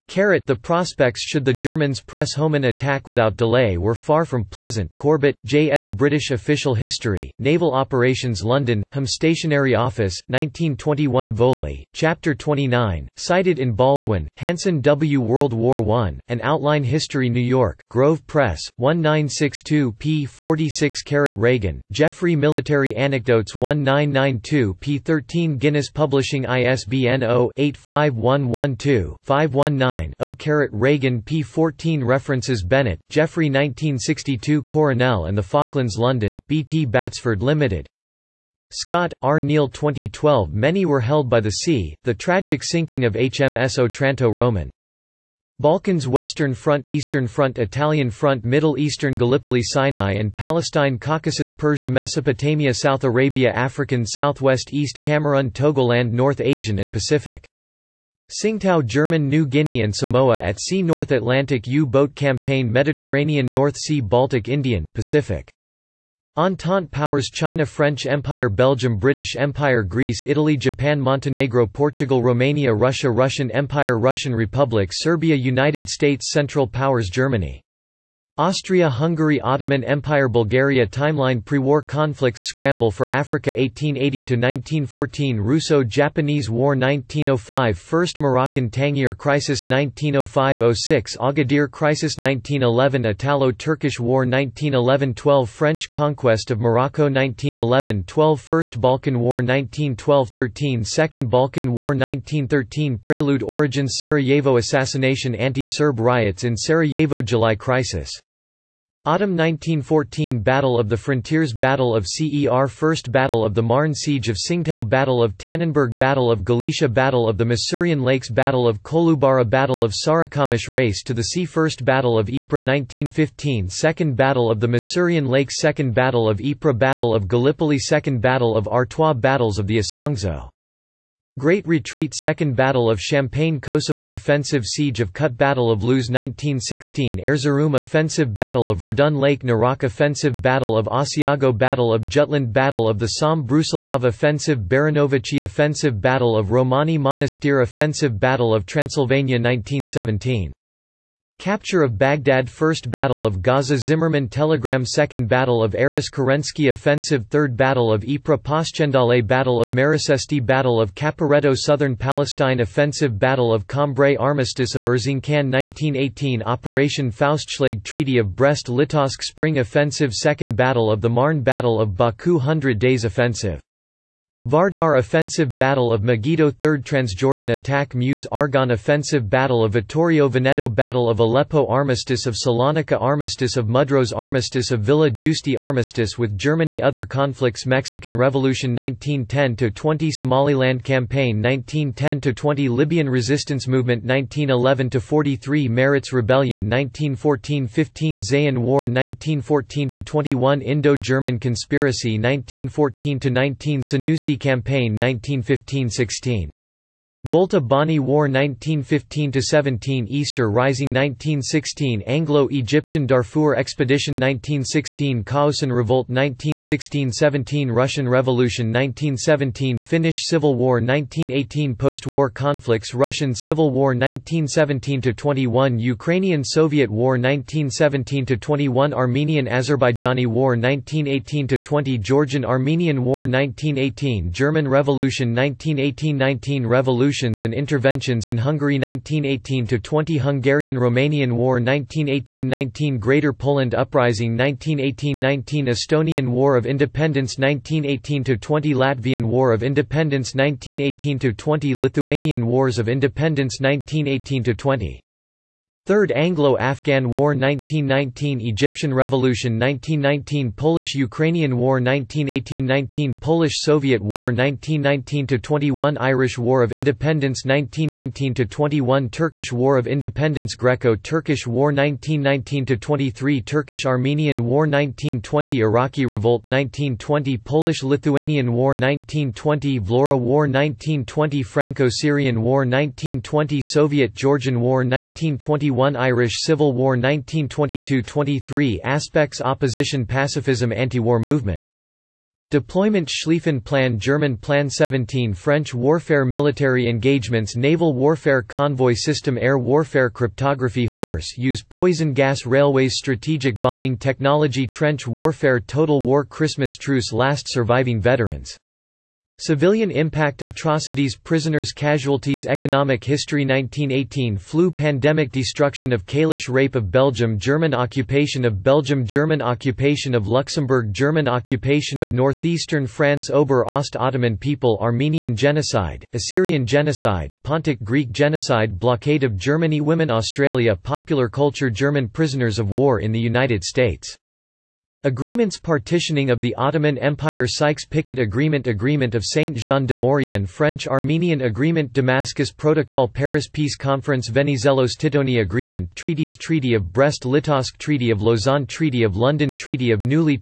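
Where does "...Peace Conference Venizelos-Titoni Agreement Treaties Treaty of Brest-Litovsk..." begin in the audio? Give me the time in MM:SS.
05:43.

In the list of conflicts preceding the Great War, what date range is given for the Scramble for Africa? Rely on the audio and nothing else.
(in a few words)
1880–1914.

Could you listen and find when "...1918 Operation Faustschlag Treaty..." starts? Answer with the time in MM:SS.
02:45.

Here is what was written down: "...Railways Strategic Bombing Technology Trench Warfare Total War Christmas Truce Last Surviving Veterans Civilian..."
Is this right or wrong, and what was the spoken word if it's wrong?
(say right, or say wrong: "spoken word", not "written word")
right.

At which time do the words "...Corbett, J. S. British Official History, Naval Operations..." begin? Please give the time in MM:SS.
00:04.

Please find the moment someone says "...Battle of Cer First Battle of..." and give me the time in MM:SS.
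01:51.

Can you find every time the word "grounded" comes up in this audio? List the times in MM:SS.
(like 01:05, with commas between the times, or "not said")
not said.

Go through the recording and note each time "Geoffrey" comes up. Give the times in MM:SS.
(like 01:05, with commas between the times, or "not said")
00:21, 00:33.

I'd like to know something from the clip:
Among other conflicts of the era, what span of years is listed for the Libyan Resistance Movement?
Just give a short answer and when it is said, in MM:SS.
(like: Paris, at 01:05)
1911–43, at 03:14.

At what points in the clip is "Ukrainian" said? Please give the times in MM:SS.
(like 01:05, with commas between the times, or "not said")
03:45, 04:20.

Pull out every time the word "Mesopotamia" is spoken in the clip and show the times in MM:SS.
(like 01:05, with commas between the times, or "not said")
00:51.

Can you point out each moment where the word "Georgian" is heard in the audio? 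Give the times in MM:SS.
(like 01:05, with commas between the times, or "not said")
03:52, 04:43.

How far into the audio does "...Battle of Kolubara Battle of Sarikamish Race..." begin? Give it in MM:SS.
01:58.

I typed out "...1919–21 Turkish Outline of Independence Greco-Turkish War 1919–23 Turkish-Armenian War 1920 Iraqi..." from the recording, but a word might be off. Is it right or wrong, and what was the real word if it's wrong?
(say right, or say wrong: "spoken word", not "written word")
wrong: "War", not "Outline".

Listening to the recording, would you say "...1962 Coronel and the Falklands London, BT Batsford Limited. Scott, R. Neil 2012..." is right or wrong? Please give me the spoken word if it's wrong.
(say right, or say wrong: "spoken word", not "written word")
right.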